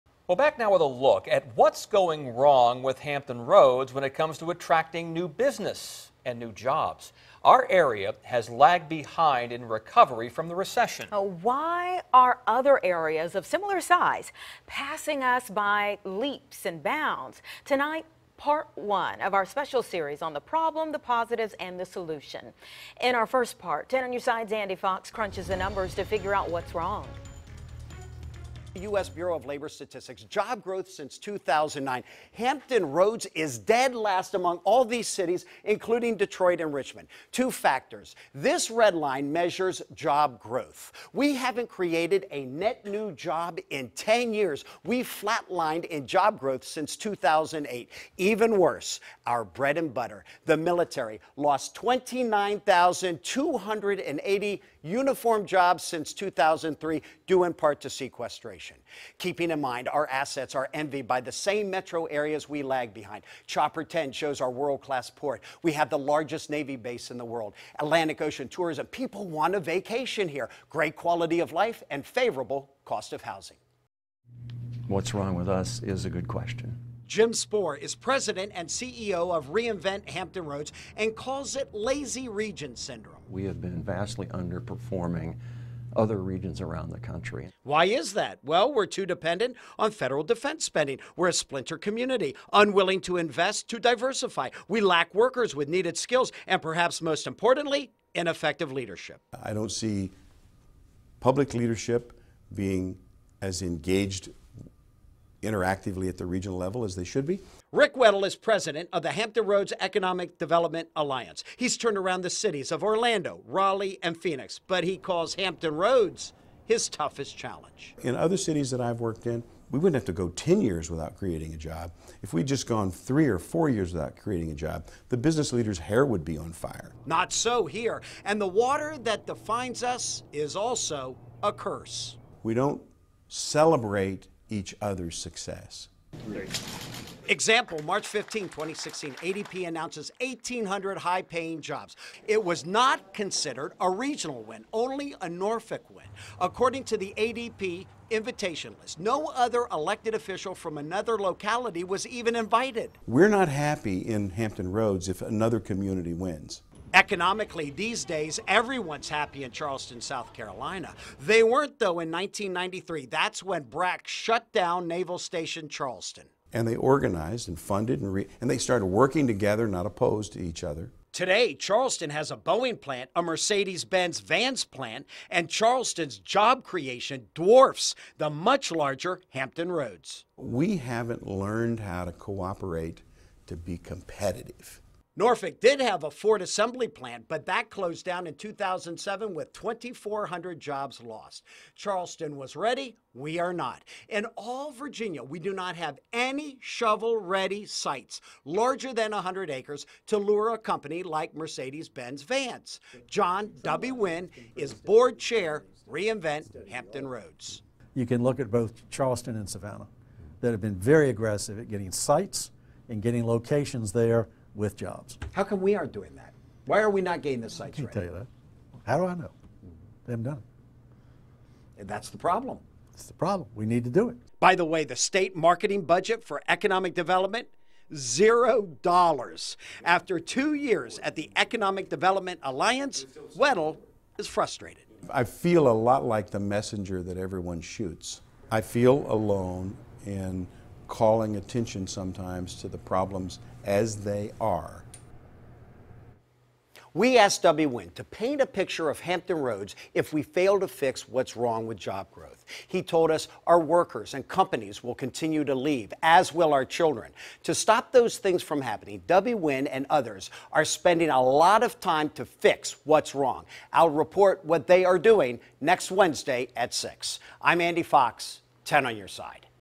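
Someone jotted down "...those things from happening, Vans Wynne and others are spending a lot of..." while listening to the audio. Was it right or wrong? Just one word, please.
wrong.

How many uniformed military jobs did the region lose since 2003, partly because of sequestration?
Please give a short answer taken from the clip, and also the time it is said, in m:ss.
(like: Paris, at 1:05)
29,280, at 0:51.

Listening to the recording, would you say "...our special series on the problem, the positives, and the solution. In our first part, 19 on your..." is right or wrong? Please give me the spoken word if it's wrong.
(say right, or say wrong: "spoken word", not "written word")
wrong: "10", not "19".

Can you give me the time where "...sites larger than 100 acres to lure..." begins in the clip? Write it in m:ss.
3:17.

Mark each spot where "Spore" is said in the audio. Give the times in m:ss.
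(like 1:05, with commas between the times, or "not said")
1:17.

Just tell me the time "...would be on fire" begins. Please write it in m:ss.
2:06.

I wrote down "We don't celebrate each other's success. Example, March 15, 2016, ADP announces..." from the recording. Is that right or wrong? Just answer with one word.
right.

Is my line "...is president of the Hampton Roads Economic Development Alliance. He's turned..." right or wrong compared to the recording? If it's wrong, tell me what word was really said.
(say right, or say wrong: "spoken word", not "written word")
right.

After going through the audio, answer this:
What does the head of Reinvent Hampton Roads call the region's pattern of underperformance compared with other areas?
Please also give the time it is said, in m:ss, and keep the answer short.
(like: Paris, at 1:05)
lazy region syndrome, at 1:21.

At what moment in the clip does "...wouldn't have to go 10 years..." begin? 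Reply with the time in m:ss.
1:59.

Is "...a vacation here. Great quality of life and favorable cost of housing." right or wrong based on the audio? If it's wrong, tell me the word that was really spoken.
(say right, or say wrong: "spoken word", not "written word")
right.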